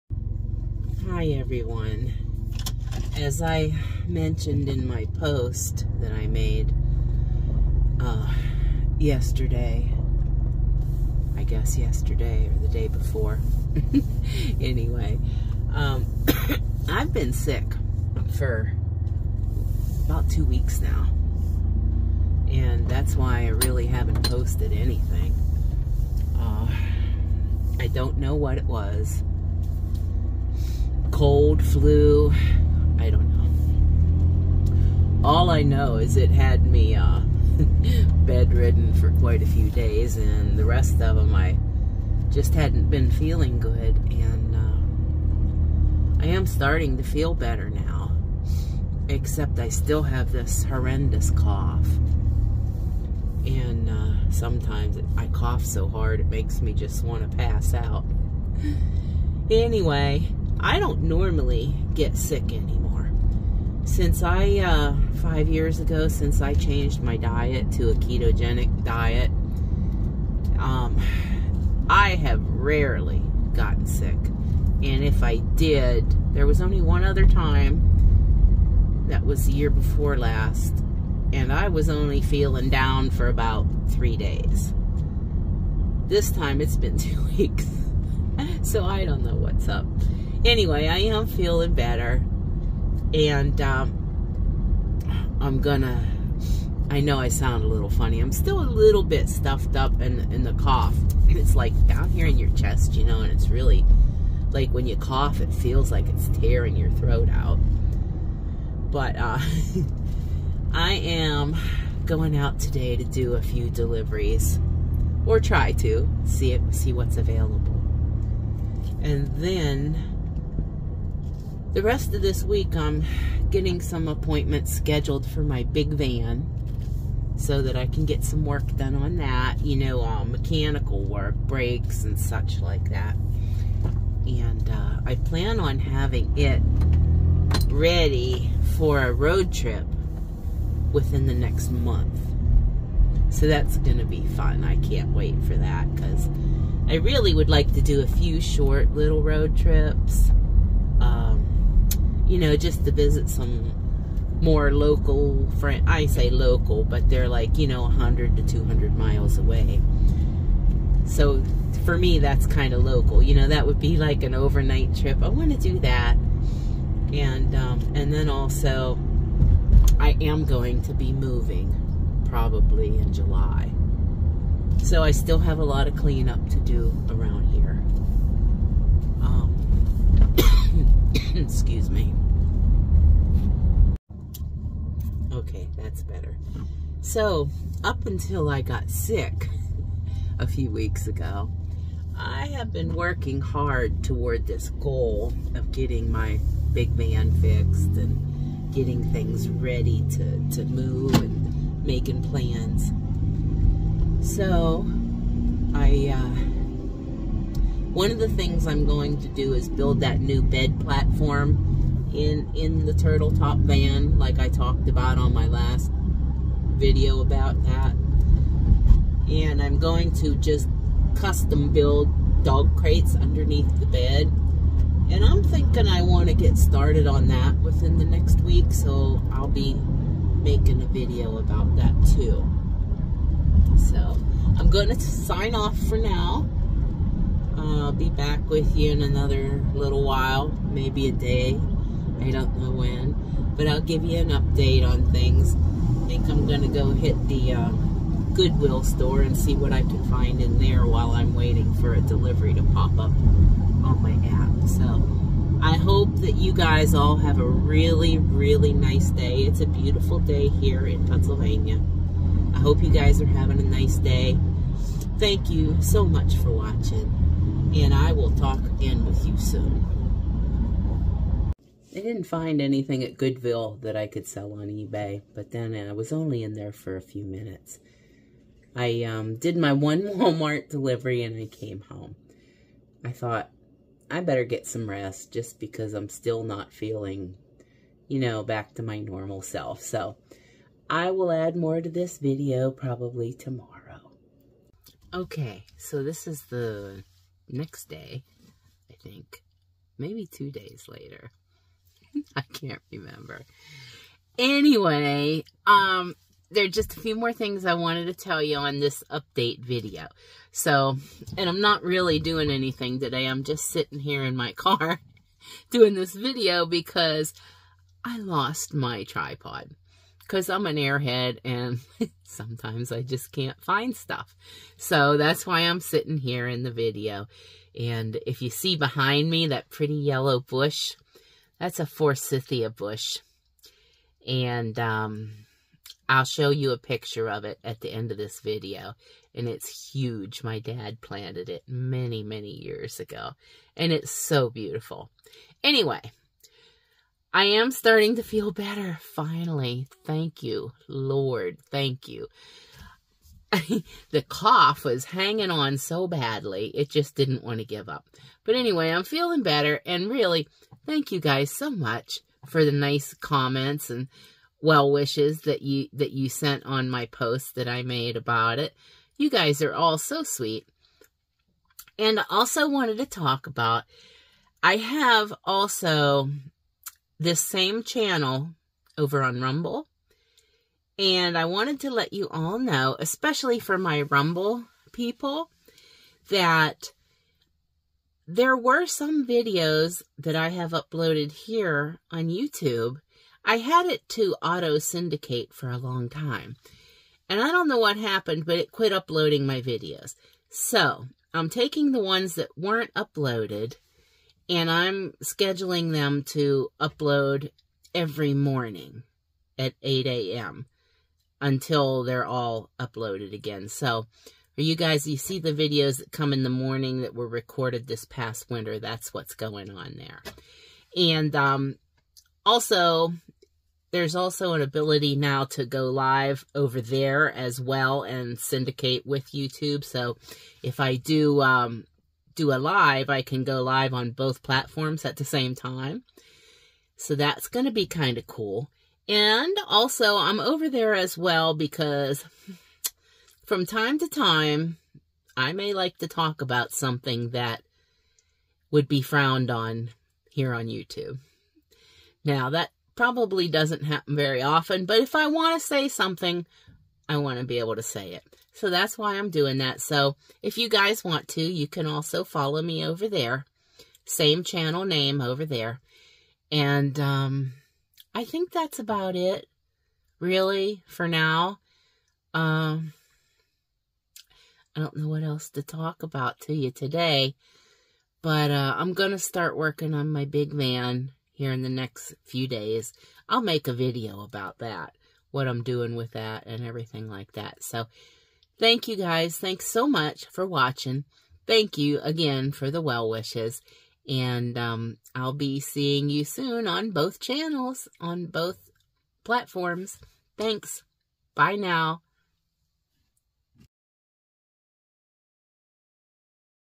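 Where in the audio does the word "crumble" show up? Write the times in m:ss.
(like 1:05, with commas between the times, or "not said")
not said.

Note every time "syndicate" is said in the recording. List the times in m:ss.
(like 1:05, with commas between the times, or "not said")
6:34, 7:08.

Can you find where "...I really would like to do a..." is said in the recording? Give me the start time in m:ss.
2:26.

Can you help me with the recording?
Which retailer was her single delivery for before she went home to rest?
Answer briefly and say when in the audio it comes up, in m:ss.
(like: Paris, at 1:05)
Walmart, at 4:40.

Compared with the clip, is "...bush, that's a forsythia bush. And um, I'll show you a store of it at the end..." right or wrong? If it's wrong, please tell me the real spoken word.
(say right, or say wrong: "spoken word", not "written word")
wrong: "picture", not "store".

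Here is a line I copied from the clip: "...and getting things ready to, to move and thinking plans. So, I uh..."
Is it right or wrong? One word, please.
wrong.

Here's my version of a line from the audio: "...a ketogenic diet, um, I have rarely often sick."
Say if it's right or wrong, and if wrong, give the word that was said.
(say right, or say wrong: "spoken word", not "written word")
wrong: "gotten", not "often".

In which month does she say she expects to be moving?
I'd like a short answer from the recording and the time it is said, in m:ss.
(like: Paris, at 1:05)
July, at 2:53.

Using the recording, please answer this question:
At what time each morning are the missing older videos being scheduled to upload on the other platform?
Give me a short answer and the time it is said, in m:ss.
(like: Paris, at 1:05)
8 a.m., at 6:49.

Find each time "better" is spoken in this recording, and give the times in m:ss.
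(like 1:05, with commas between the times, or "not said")
0:47, 1:31, 3:06, 4:44, 5:48, 5:59.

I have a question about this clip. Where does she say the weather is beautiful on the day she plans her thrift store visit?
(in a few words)
Pennsylvania.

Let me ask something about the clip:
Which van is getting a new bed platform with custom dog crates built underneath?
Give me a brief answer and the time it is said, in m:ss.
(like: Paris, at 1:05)
Turtle Top van, at 3:32.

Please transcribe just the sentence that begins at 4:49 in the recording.
So I will add more to this video probably tomorrow.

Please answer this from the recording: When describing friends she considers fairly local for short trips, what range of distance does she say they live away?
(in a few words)
100 to 200 miles.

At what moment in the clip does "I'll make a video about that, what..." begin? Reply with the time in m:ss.
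8:03.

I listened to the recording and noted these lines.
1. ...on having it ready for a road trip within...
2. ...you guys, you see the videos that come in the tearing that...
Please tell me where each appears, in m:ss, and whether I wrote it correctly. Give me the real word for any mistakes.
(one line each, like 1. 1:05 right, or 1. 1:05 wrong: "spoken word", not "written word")
1. 2:15 right
2. 6:54 wrong: "morning", not "tearing".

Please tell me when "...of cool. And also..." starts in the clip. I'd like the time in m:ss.
7:18.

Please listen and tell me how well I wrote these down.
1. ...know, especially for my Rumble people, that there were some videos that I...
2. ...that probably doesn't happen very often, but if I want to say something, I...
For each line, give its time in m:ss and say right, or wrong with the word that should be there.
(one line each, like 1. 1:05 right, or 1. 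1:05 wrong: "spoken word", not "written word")
1. 6:22 right
2. 7:32 right.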